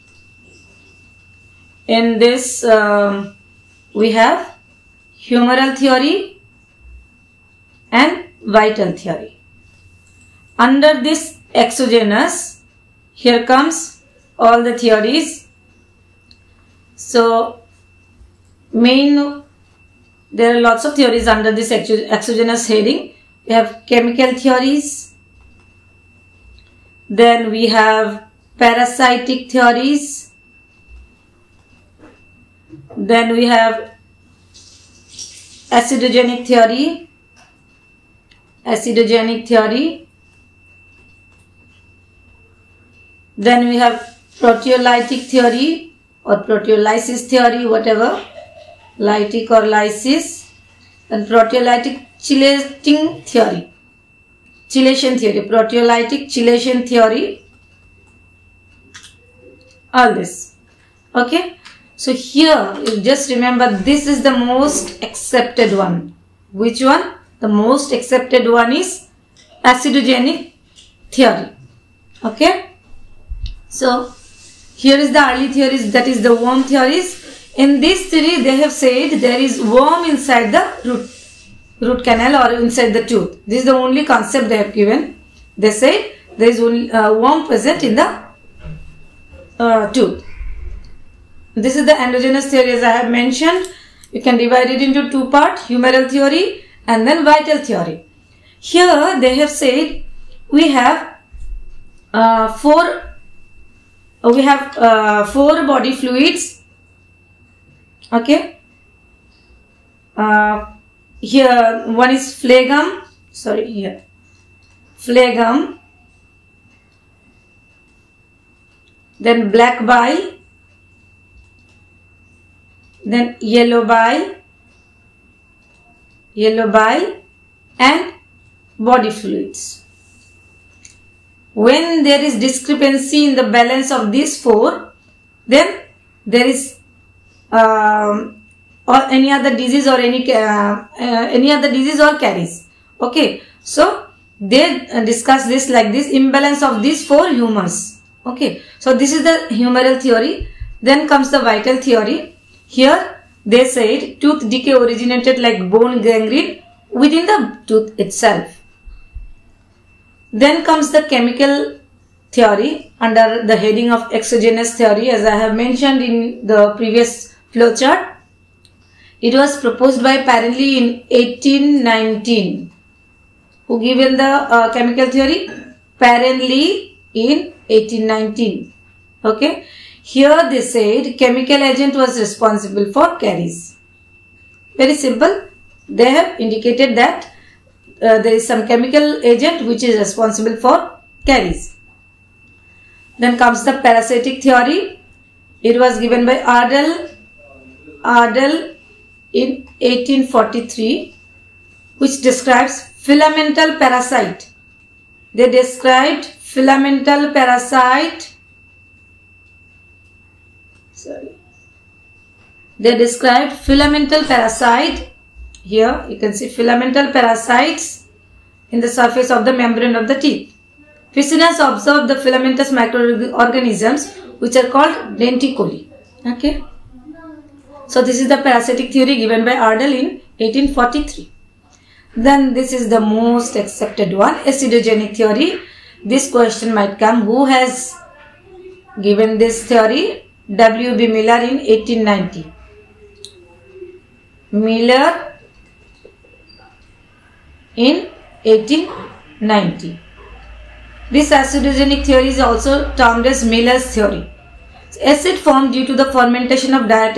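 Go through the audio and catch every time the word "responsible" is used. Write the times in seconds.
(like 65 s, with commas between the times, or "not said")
182 s, 189 s.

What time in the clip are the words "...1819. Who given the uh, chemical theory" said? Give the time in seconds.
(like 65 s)
171 s.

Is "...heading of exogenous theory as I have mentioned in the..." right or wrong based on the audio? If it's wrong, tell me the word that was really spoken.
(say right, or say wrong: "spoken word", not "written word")
right.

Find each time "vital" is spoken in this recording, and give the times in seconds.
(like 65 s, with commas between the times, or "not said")
8 s, 97 s, 151 s.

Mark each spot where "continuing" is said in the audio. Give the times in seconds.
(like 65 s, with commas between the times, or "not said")
not said.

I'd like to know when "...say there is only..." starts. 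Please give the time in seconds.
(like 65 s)
85 s.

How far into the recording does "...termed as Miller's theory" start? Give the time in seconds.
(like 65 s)
252 s.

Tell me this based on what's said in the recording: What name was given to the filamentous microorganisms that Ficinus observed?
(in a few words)
denticoli.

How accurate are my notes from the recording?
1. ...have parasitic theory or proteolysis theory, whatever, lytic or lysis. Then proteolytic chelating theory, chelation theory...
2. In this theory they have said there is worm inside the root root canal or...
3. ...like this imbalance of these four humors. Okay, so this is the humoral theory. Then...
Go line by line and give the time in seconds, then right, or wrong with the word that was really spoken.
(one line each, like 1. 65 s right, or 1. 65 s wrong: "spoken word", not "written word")
1. 43 s wrong: "proteolytic", not "parasitic"
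2. 77 s right
3. 145 s right.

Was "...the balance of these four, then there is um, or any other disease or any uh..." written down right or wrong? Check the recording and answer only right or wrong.
right.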